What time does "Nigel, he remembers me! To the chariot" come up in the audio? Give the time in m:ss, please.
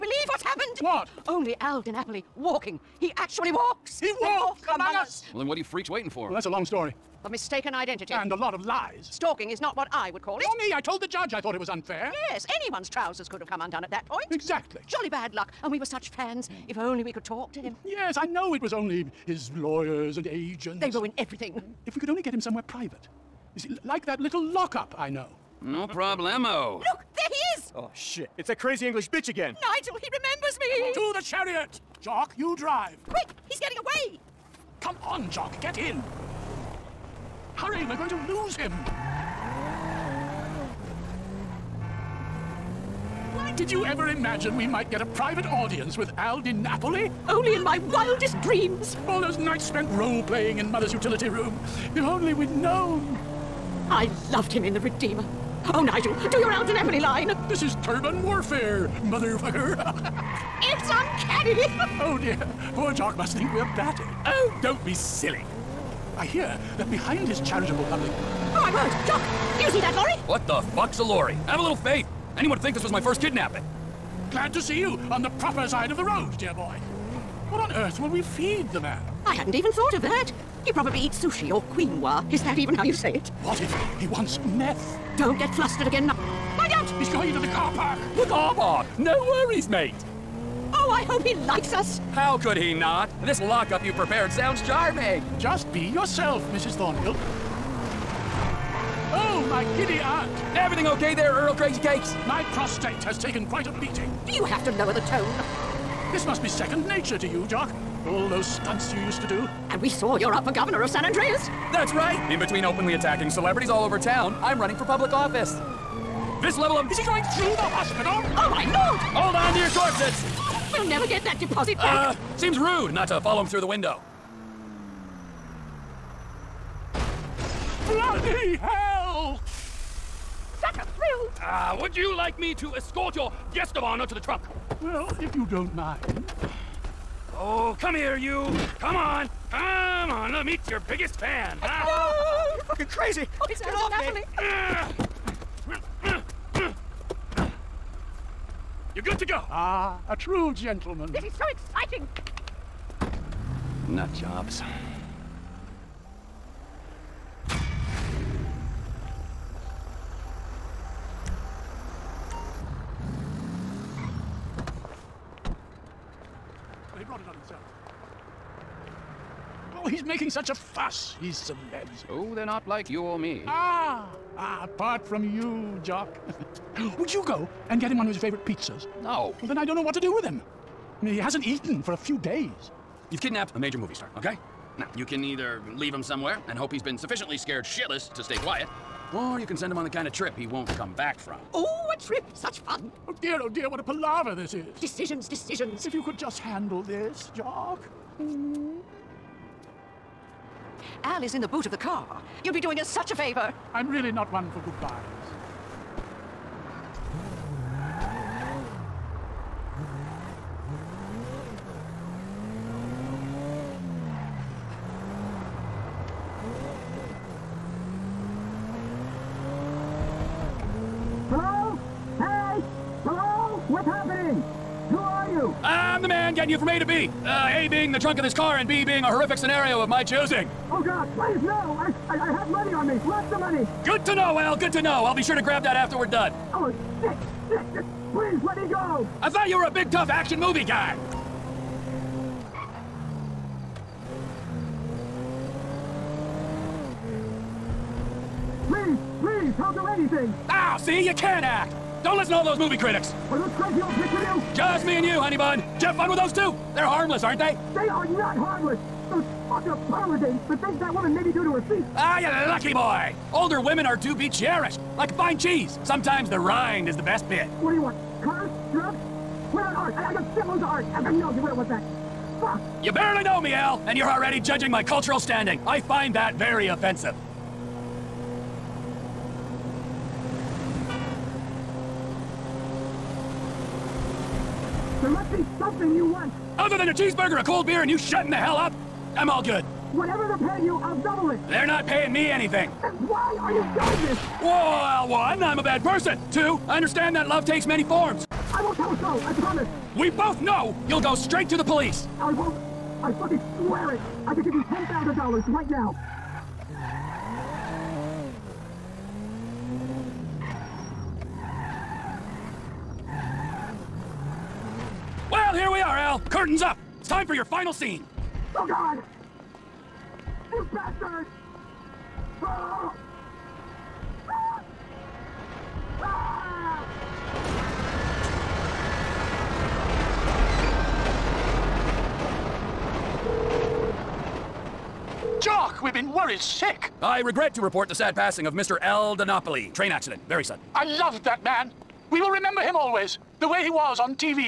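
0:29.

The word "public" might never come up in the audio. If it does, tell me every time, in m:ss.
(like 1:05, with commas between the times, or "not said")
1:07, 1:54.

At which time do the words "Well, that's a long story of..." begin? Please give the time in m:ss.
0:06.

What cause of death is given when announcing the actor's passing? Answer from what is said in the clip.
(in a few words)
Train accident.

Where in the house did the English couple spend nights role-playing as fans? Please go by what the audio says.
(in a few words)
Mother's utility room.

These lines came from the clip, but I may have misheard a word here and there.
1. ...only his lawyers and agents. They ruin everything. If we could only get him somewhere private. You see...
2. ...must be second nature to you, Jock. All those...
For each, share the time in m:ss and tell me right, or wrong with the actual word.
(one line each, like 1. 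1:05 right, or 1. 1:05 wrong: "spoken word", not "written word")
1. 0:18 right
2. 1:46 right.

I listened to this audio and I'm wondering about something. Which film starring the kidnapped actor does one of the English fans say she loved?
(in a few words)
The Redeemer.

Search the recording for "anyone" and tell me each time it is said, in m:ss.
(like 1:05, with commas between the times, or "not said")
0:12, 1:12.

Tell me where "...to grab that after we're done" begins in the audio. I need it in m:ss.
3:55.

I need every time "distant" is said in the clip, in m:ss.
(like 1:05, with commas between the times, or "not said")
not said.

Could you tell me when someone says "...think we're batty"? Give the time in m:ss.
1:03.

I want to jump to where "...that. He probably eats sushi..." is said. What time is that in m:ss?
1:20.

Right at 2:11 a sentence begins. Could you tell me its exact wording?
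Ah, uh, would you like me to escort your guest of honor to the trunk?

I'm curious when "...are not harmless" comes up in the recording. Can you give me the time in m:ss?
4:17.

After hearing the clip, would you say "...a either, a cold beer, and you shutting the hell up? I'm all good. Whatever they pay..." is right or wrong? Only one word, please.
wrong.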